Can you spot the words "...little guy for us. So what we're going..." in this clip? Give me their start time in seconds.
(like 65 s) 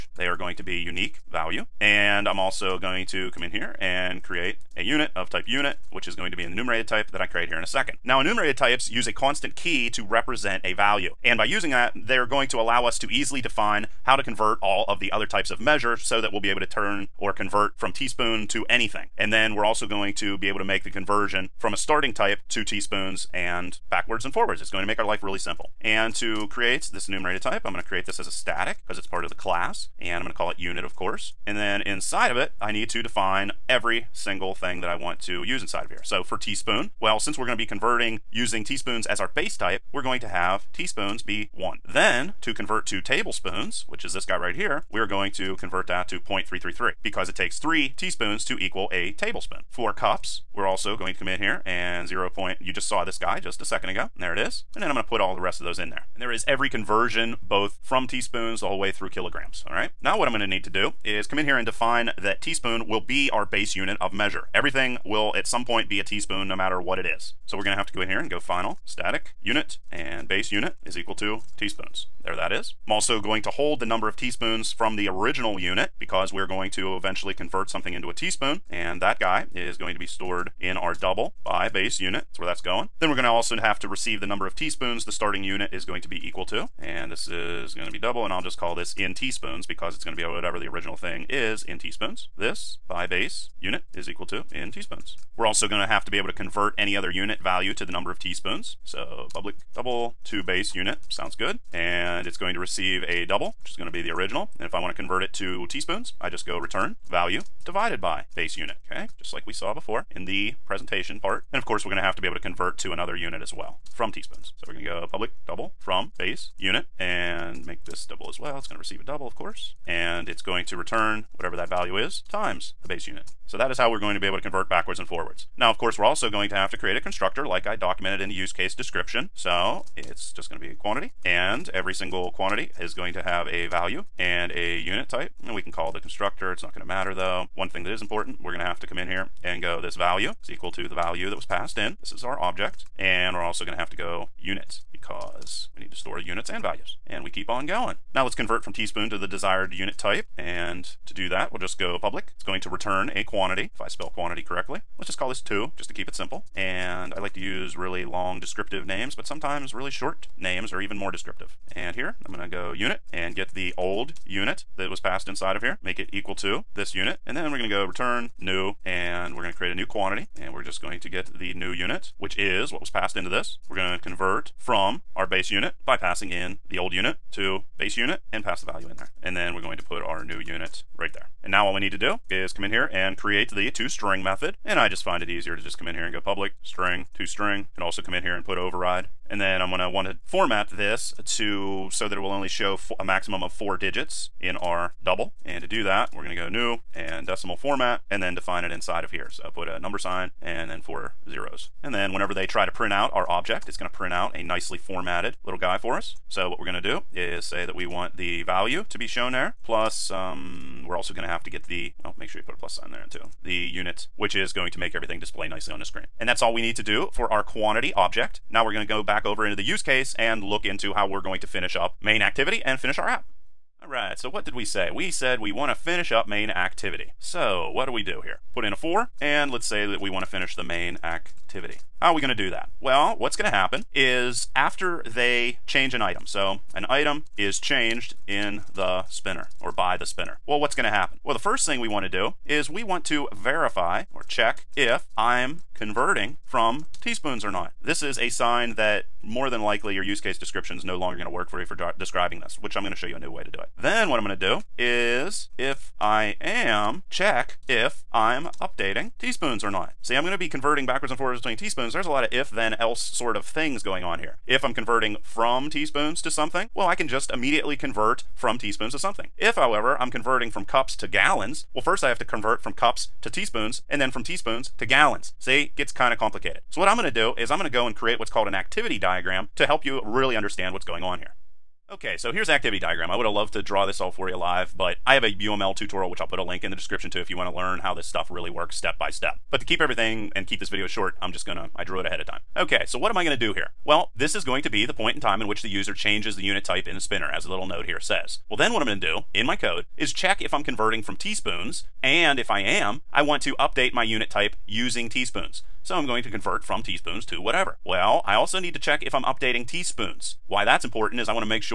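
205 s.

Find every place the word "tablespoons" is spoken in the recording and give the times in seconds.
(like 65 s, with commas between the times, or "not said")
42 s, 49 s.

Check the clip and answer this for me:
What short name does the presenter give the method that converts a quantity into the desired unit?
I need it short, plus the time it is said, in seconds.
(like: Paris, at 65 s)
2, at 154 s.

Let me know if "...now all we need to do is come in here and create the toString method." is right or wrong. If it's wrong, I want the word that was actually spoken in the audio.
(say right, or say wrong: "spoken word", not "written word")
right.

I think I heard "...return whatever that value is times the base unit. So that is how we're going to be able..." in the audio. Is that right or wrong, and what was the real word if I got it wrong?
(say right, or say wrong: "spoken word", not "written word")
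right.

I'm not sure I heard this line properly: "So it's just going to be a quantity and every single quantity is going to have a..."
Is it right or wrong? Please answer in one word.
right.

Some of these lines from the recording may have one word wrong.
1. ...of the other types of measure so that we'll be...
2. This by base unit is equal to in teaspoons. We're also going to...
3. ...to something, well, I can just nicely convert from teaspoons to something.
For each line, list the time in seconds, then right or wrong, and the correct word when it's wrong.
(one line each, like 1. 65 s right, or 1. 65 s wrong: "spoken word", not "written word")
1. 14 s right
2. 92 s right
3. 266 s wrong: "immediately", not "nicely".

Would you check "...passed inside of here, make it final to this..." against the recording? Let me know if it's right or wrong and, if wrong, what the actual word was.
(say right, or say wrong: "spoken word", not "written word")
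wrong: "equal", not "final".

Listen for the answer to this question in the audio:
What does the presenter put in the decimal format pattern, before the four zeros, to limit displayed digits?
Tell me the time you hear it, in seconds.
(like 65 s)
199 s.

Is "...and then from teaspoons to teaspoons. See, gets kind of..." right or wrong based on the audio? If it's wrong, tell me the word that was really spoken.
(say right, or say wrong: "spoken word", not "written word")
wrong: "gallons", not "teaspoons".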